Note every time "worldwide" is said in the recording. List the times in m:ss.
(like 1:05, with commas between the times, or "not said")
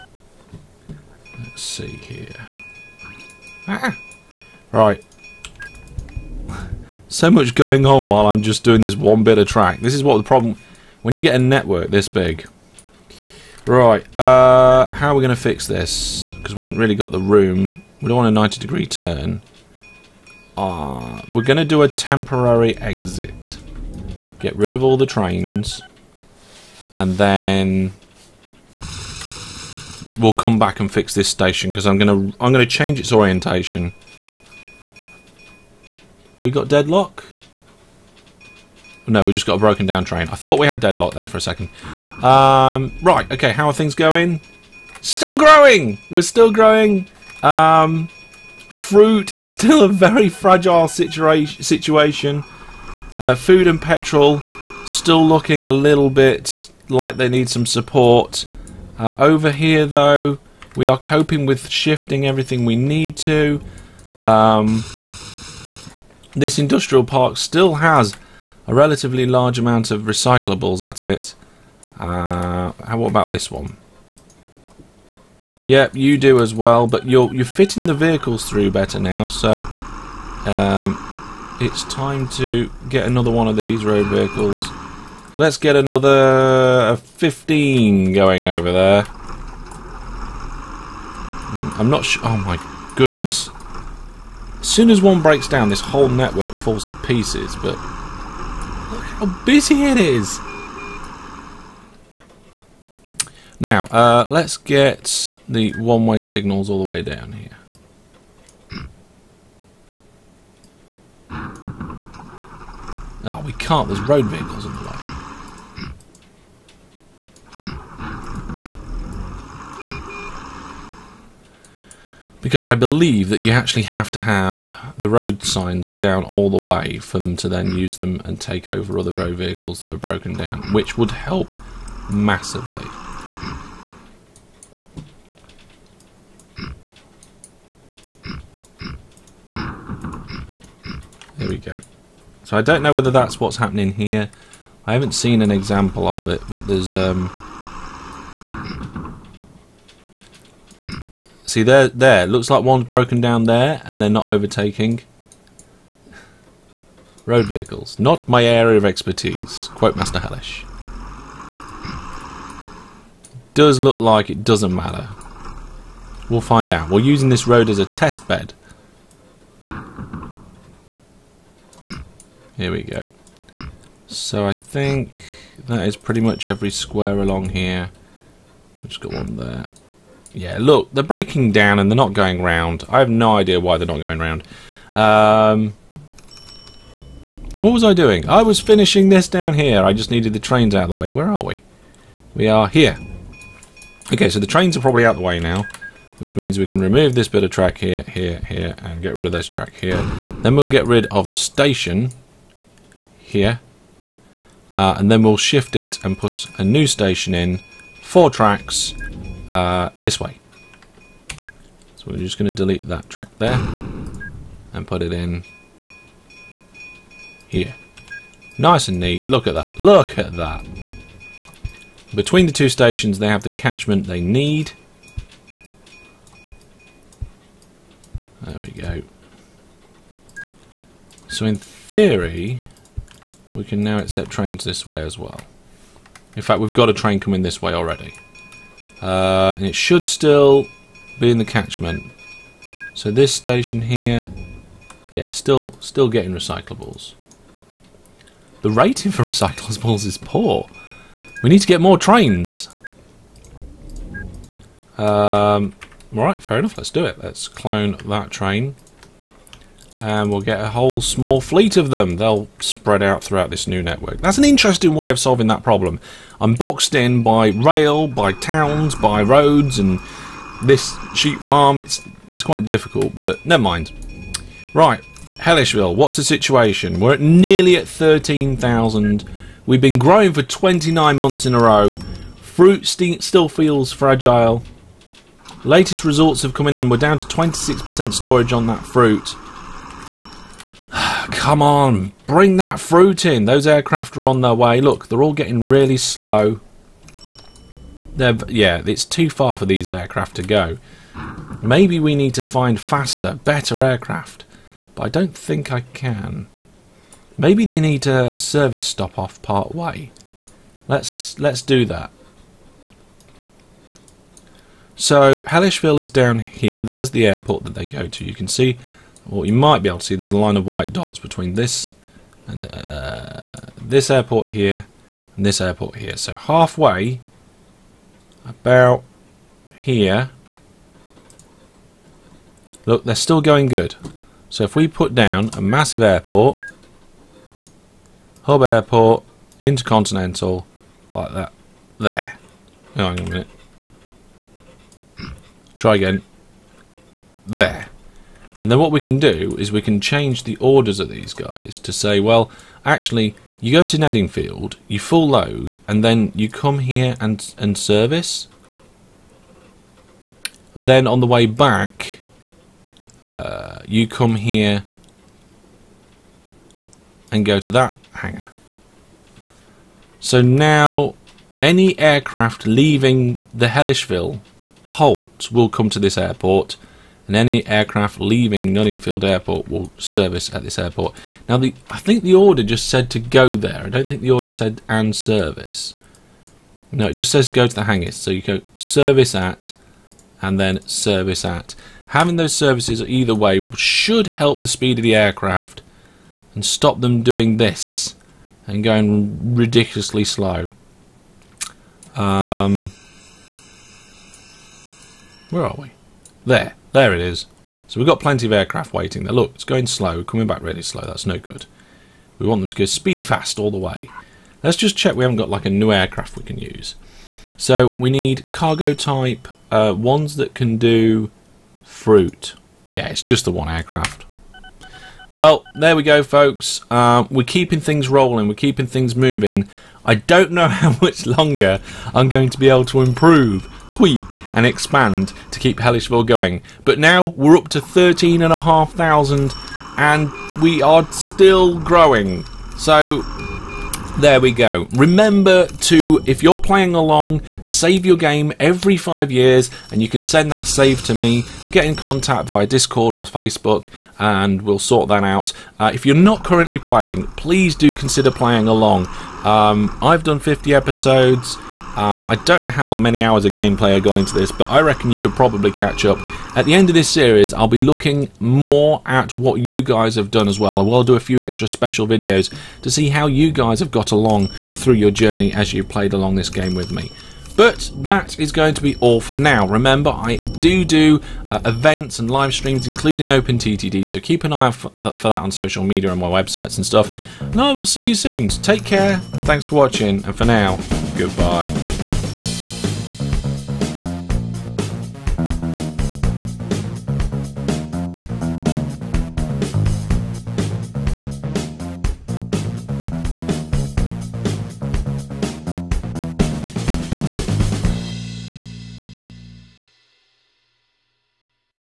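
not said.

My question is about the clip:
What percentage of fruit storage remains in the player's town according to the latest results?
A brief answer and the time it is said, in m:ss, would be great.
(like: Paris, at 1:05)
26%, at 4:47.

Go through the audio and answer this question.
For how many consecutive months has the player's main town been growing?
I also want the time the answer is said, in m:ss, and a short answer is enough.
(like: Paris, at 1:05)
29, at 4:40.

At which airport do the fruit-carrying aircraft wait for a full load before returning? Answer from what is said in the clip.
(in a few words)
Nunningfield Airport.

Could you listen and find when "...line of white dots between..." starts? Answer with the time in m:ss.
5:20.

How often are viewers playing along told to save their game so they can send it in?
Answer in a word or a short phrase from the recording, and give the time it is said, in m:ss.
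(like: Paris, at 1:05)
Every five years, at 7:28.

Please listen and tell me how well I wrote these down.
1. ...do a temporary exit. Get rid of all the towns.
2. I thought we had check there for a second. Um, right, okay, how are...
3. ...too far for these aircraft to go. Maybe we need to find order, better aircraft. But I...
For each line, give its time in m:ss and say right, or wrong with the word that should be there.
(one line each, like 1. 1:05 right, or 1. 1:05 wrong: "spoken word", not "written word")
1. 0:21 wrong: "trains", not "towns"
2. 0:40 wrong: "deadlock", not "check"
3. 4:59 wrong: "faster", not "order".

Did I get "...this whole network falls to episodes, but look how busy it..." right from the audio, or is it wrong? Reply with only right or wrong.
wrong.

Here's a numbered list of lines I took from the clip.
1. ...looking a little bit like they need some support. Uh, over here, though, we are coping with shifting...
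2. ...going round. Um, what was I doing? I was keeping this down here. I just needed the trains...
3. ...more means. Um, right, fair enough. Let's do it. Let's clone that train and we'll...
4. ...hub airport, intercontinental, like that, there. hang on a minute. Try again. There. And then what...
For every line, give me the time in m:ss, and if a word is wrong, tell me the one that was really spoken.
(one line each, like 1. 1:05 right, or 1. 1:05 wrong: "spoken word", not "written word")
1. 0:55 right
2. 3:04 wrong: "finishing", not "keeping"
3. 4:11 wrong: "trains", not "means"
4. 5:38 right.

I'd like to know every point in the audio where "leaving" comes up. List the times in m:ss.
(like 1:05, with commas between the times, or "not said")
6:12, 6:18.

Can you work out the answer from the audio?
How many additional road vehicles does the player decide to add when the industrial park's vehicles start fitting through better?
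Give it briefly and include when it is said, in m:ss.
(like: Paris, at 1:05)
15, at 1:26.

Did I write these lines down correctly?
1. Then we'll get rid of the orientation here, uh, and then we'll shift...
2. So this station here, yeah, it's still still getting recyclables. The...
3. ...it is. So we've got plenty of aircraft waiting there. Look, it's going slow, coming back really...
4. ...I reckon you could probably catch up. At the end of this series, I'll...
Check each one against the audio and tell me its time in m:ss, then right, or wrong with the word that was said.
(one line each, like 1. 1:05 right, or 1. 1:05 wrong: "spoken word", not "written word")
1. 3:20 wrong: "station", not "orientation"
2. 4:02 right
3. 6:47 right
4. 7:44 right.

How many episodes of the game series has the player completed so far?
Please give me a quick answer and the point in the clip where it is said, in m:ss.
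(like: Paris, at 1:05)
50, at 7:40.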